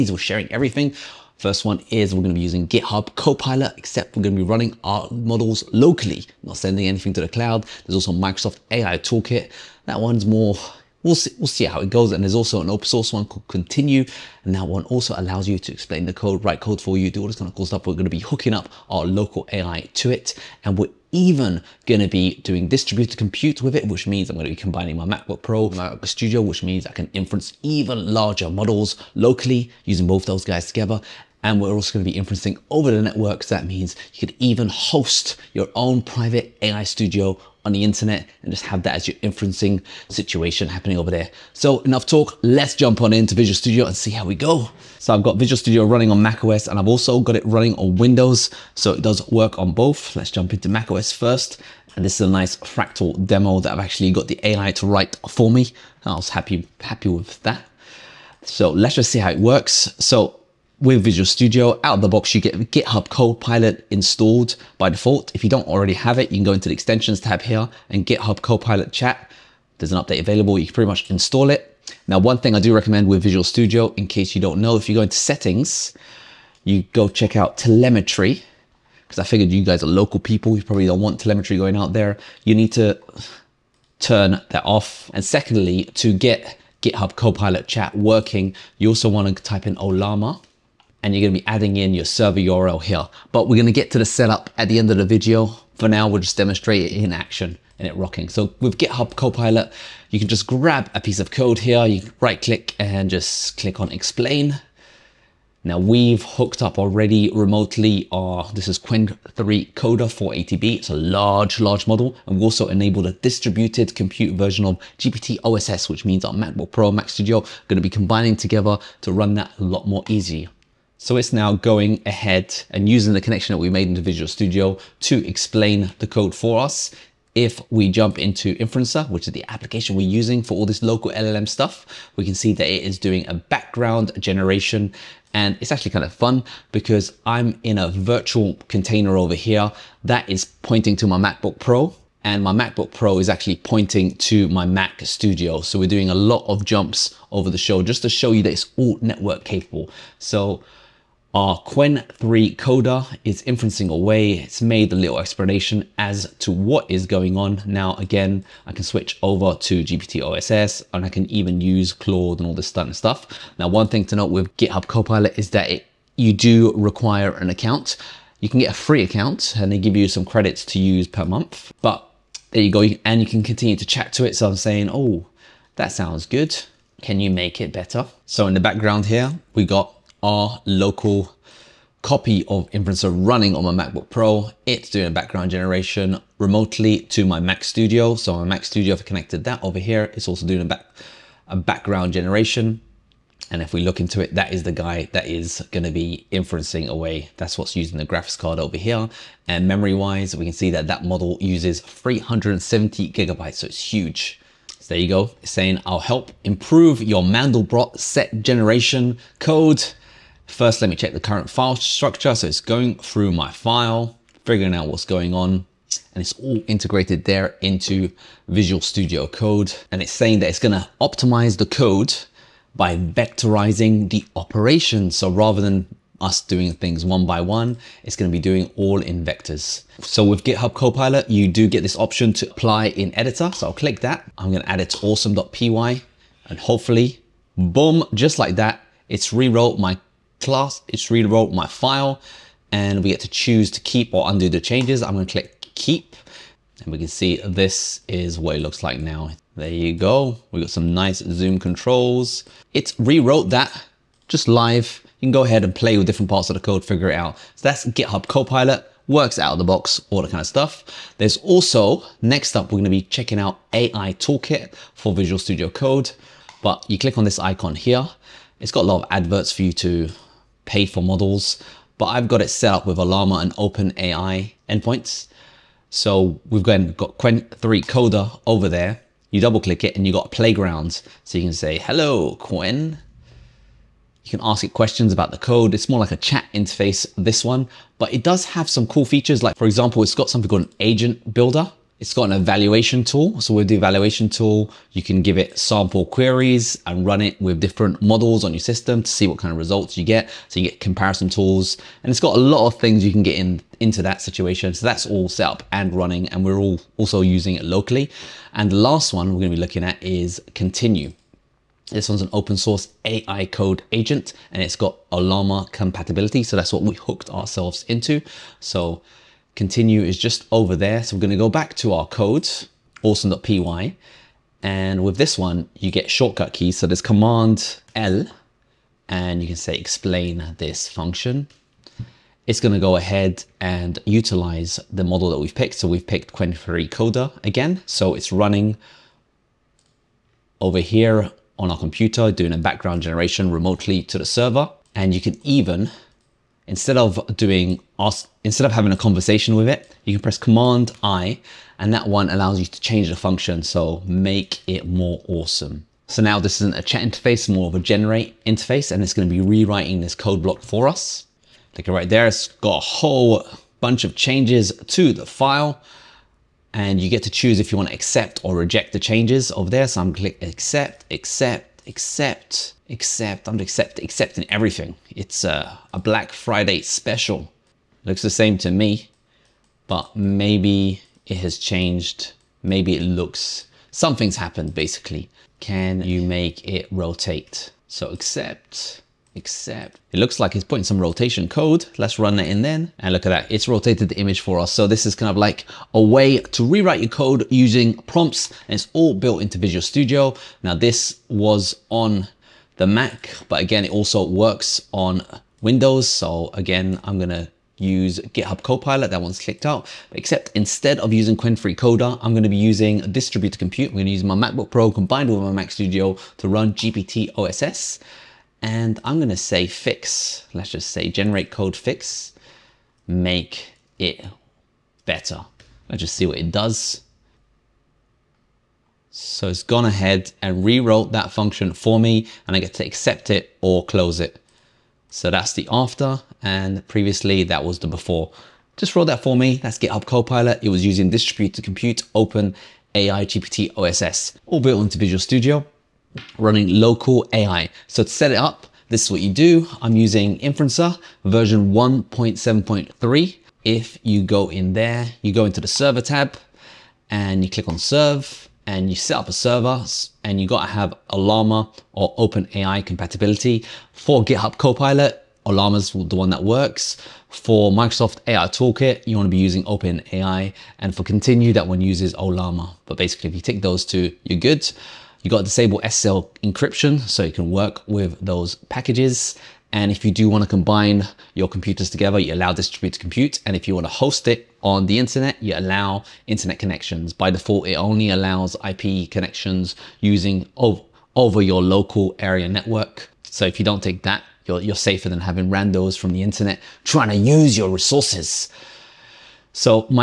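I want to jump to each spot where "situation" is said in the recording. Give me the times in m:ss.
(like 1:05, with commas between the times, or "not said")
0:40, 5:04.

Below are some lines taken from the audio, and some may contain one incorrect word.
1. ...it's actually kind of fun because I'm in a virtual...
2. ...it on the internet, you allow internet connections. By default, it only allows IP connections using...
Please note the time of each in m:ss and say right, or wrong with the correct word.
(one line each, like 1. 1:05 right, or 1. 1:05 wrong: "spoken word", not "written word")
1. 2:15 right
2. 8:04 right.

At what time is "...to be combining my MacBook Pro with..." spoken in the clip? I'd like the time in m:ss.
0:24.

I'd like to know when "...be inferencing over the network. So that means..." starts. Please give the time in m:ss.
0:32.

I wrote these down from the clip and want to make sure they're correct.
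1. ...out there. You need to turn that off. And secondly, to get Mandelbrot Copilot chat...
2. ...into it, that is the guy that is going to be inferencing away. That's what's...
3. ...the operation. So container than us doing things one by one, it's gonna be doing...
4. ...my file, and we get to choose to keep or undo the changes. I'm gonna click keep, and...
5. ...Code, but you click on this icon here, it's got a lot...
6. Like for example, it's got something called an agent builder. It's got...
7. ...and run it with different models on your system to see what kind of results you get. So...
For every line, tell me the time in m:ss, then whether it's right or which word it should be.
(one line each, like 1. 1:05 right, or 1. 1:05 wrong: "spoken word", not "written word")
1. 1:21 wrong: "GitHub", not "Mandelbrot"
2. 3:13 right
3. 3:44 wrong: "rather", not "container"
4. 4:01 right
5. 4:25 right
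6. 4:49 right
7. 4:56 right.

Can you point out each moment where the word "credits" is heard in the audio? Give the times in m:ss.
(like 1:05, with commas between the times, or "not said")
2:50.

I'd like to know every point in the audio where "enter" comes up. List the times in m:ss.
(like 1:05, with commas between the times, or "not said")
not said.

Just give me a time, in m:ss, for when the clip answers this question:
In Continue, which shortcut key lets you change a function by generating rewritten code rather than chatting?
5:50.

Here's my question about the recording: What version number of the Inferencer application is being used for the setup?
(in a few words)
1.7.3.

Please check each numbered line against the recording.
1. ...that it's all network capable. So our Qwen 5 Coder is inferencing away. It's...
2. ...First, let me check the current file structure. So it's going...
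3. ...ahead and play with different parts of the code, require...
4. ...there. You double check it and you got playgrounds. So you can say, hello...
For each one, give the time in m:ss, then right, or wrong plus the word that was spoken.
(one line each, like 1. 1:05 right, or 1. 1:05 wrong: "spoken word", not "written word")
1. 2:28 wrong: "3", not "5"
2. 3:30 right
3. 4:15 wrong: "figure", not "require"
4. 4:38 wrong: "click", not "check".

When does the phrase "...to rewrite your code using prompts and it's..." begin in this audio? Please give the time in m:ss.
6:36.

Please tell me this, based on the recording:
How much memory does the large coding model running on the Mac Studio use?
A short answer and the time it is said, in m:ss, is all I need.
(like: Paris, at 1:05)
370 gigabytes, at 3:21.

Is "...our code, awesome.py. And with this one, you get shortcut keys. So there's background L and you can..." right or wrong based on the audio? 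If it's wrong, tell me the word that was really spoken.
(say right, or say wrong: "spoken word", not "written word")
wrong: "command", not "background".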